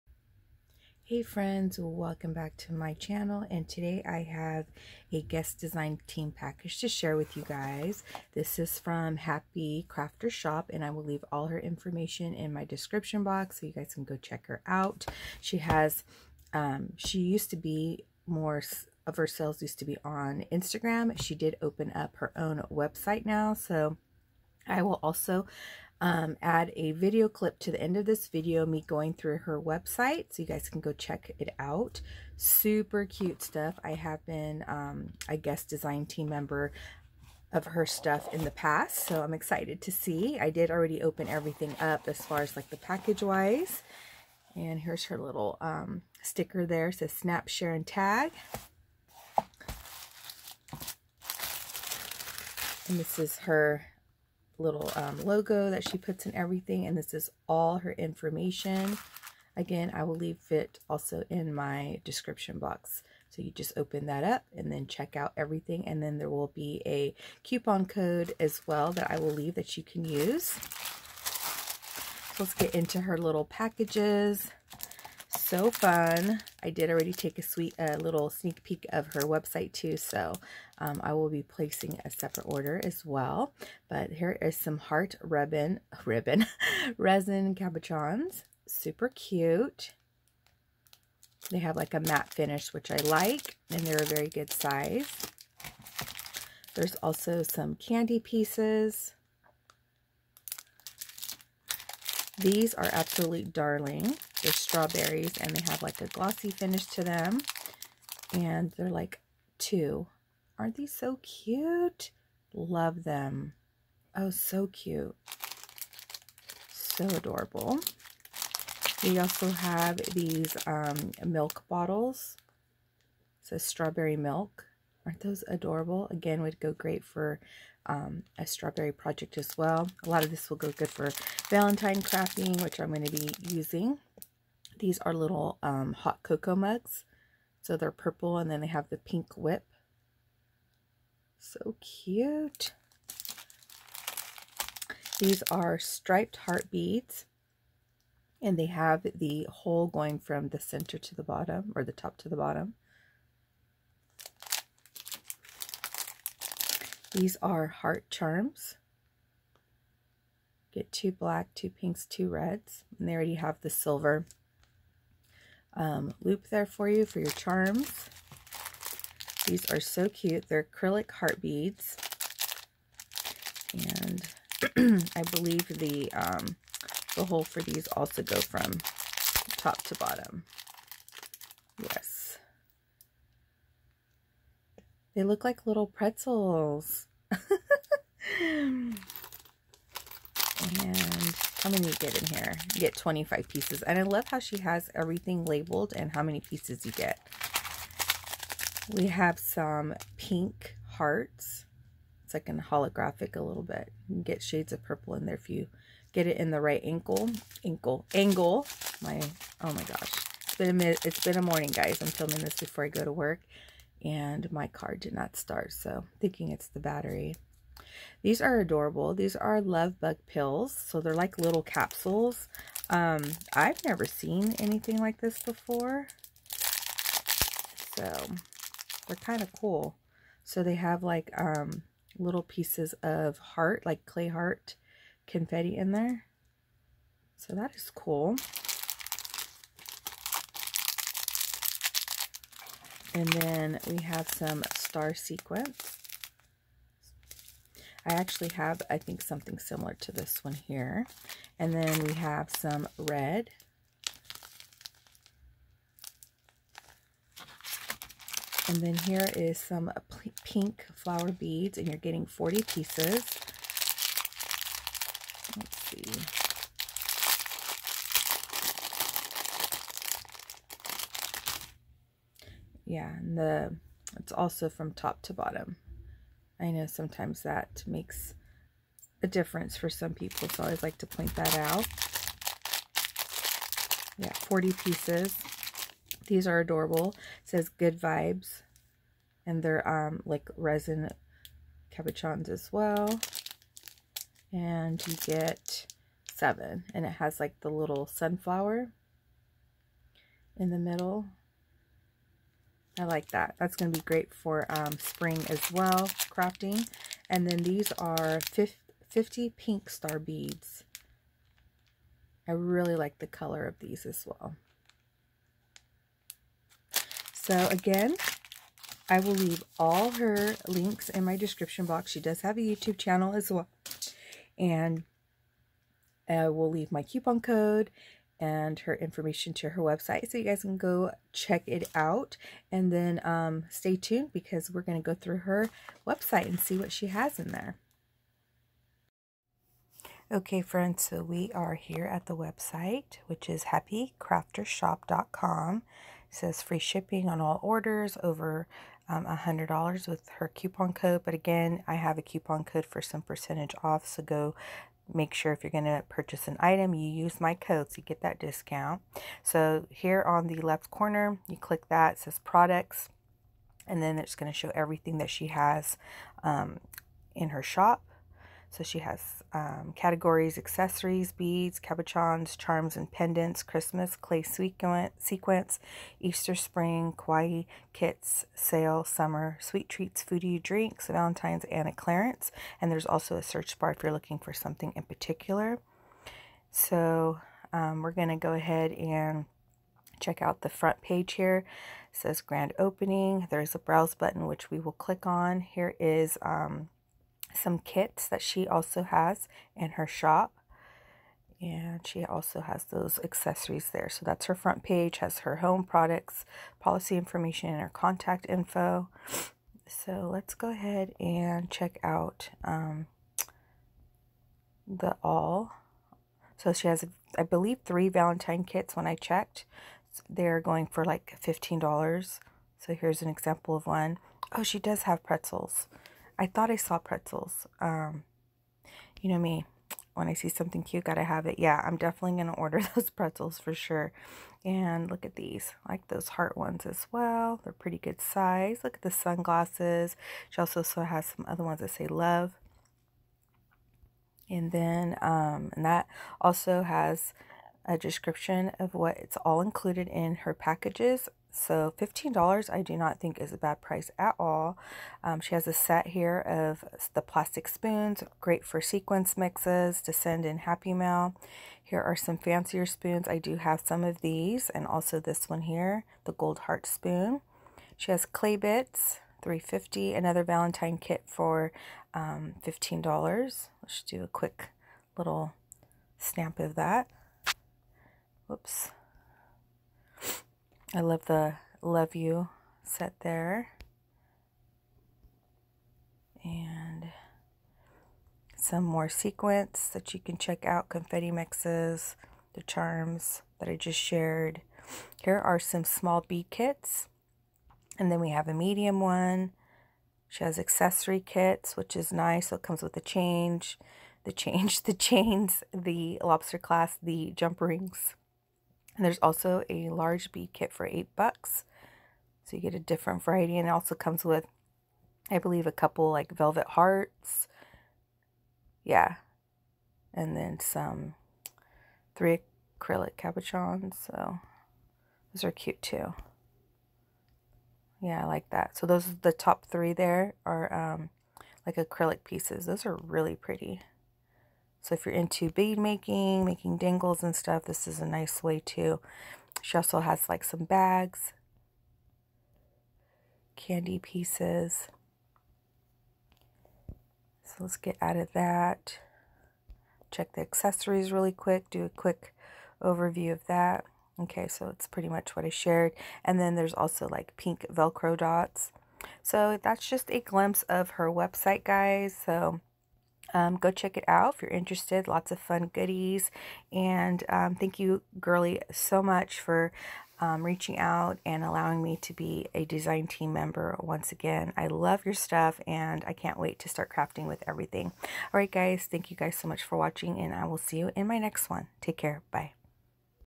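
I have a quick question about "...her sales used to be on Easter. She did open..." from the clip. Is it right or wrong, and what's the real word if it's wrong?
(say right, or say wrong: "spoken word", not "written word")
wrong: "Instagram", not "Easter".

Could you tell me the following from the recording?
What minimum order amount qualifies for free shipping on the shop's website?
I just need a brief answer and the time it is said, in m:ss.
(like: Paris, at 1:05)
$100, at 5:49.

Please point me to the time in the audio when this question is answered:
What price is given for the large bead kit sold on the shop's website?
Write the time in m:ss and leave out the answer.
8:30.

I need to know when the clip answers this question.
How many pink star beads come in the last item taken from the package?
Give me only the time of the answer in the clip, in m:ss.
5:08.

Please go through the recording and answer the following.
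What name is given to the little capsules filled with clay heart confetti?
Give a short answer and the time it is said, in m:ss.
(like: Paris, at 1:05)
Love Bug Pills, at 3:39.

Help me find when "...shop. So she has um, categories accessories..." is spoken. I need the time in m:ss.
6:07.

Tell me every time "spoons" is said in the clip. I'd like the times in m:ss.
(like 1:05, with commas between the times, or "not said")
7:37, 7:42, 7:46.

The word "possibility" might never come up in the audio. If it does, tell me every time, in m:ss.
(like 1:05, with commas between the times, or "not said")
not said.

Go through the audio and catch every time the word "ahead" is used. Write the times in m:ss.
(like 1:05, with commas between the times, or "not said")
6:28, 6:50.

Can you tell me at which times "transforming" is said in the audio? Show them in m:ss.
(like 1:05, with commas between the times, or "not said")
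not said.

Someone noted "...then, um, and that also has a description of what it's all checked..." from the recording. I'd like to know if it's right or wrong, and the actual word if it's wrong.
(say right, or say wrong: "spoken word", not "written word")
wrong: "included", not "checked".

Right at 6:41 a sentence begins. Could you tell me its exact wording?
And she also has those accessories there.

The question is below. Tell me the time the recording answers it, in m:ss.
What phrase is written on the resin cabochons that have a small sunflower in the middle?
4:47.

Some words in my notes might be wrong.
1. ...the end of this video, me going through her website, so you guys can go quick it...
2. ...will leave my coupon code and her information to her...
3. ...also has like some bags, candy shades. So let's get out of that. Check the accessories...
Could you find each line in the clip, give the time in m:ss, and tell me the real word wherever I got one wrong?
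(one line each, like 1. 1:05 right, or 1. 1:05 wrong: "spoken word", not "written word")
1. 0:27 wrong: "check", not "quick"
2. 5:26 right
3. 8:59 wrong: "pieces", not "shades".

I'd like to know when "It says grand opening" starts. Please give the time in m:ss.
6:32.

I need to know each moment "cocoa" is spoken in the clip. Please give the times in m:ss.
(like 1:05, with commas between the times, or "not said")
2:16.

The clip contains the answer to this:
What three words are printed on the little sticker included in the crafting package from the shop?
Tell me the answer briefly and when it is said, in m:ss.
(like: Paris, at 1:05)
Snap, share, and tag, at 0:47.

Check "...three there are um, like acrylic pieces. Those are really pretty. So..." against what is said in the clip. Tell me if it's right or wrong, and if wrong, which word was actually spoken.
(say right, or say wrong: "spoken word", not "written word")
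right.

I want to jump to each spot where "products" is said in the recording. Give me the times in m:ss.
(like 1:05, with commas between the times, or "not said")
6:02, 6:45.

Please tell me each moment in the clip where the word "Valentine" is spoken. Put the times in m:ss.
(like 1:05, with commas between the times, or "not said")
2:11, 6:21, 6:58, 7:50.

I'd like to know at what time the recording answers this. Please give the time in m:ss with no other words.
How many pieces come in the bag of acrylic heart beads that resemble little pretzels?
3:12.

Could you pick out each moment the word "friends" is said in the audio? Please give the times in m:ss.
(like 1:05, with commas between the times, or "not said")
0:01, 5:40.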